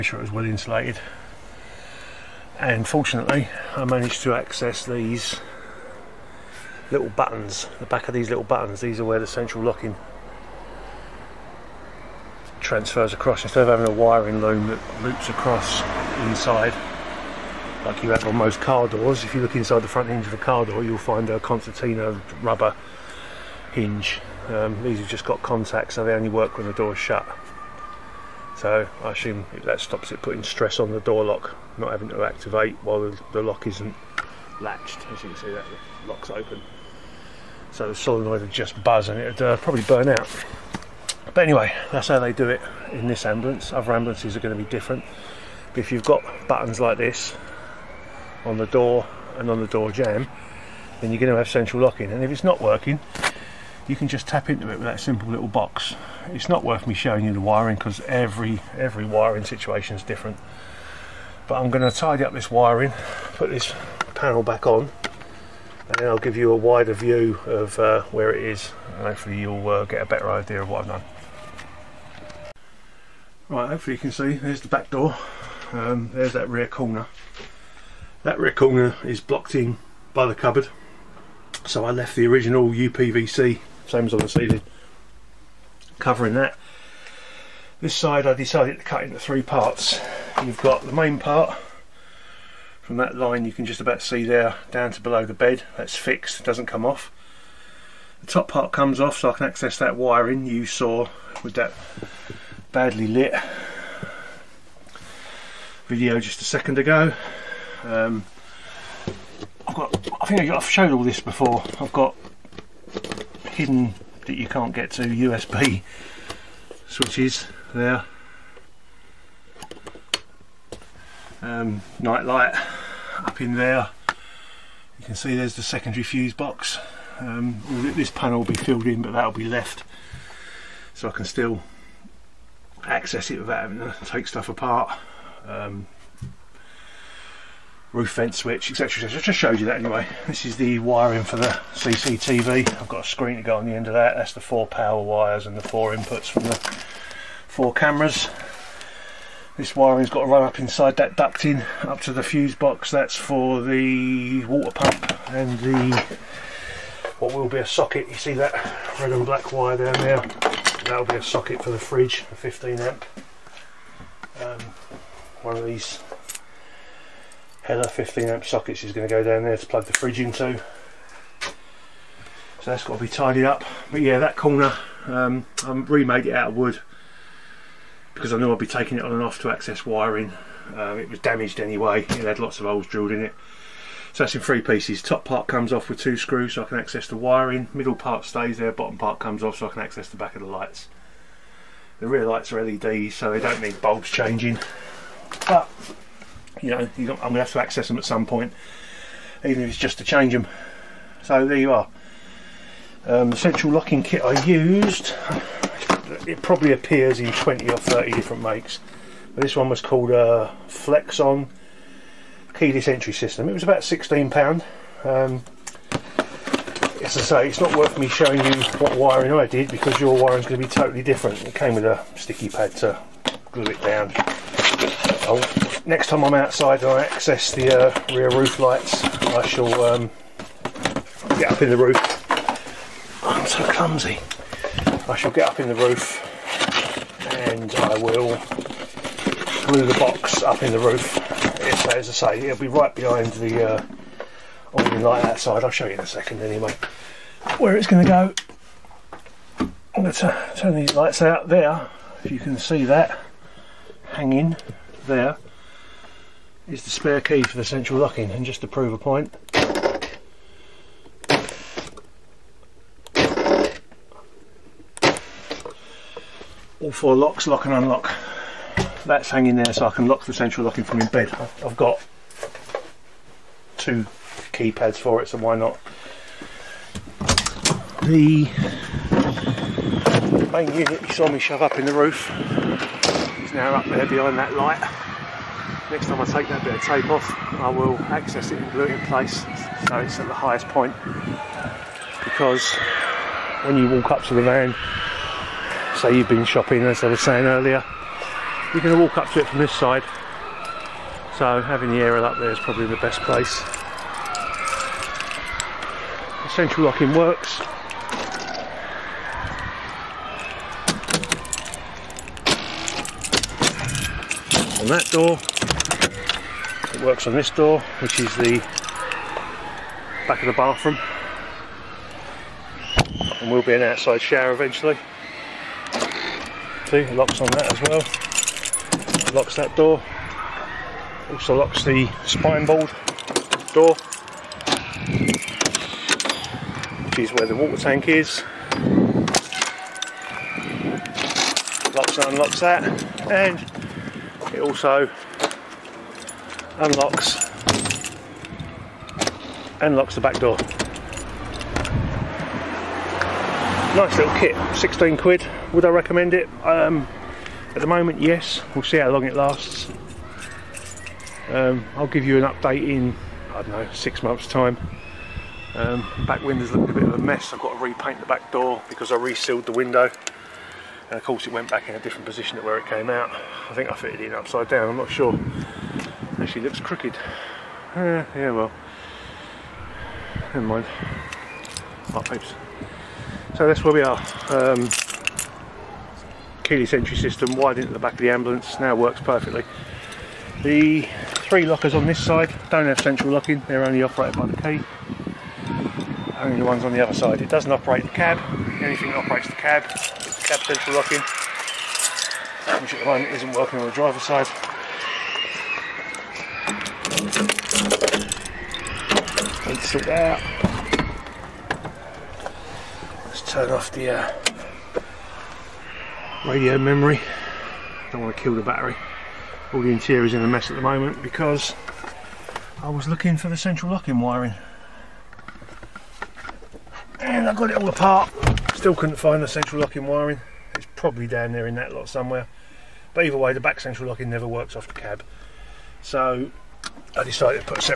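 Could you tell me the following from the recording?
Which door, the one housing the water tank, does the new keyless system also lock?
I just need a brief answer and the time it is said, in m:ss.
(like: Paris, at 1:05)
Spine board door, at 5:32.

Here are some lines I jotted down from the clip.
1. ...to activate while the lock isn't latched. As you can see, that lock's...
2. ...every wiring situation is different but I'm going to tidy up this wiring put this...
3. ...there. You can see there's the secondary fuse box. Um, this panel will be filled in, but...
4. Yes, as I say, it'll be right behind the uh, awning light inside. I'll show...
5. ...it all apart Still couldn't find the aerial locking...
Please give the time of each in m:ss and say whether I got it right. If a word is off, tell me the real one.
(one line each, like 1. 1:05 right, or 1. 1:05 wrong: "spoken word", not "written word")
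1. 0:32 right
2. 0:58 right
3. 2:03 right
4. 4:01 wrong: "outside", not "inside"
5. 7:07 wrong: "central", not "aerial".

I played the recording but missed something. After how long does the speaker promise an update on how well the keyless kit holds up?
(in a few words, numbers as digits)
6 months.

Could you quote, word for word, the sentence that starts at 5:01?
So having the aerial up there is probably the best place.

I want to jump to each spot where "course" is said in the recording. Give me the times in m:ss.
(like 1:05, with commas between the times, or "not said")
6:11.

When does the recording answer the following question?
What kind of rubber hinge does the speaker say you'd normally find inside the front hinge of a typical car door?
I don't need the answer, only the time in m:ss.
0:21.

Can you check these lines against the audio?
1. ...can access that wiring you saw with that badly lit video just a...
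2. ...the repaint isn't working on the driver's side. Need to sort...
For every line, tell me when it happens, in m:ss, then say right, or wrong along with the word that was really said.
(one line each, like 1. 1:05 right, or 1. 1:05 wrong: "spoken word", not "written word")
1. 1:39 right
2. 6:43 wrong: "moment", not "repaint".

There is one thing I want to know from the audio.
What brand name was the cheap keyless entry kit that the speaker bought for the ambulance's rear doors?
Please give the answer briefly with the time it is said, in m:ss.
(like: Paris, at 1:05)
Flexon, at 3:30.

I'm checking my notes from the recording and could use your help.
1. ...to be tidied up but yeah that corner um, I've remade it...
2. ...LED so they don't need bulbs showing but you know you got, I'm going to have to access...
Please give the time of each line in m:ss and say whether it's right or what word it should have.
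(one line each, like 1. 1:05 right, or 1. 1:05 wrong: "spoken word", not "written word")
1. 2:52 right
2. 3:12 wrong: "changing", not "showing".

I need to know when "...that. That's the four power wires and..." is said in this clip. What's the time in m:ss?
2:23.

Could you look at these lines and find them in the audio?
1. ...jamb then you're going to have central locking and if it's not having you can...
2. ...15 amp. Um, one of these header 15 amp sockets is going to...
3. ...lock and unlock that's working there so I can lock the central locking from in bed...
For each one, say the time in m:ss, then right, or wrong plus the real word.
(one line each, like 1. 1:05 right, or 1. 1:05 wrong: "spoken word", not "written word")
1. 0:49 wrong: "working", not "having"
2. 2:42 right
3. 4:27 wrong: "hanging", not "working".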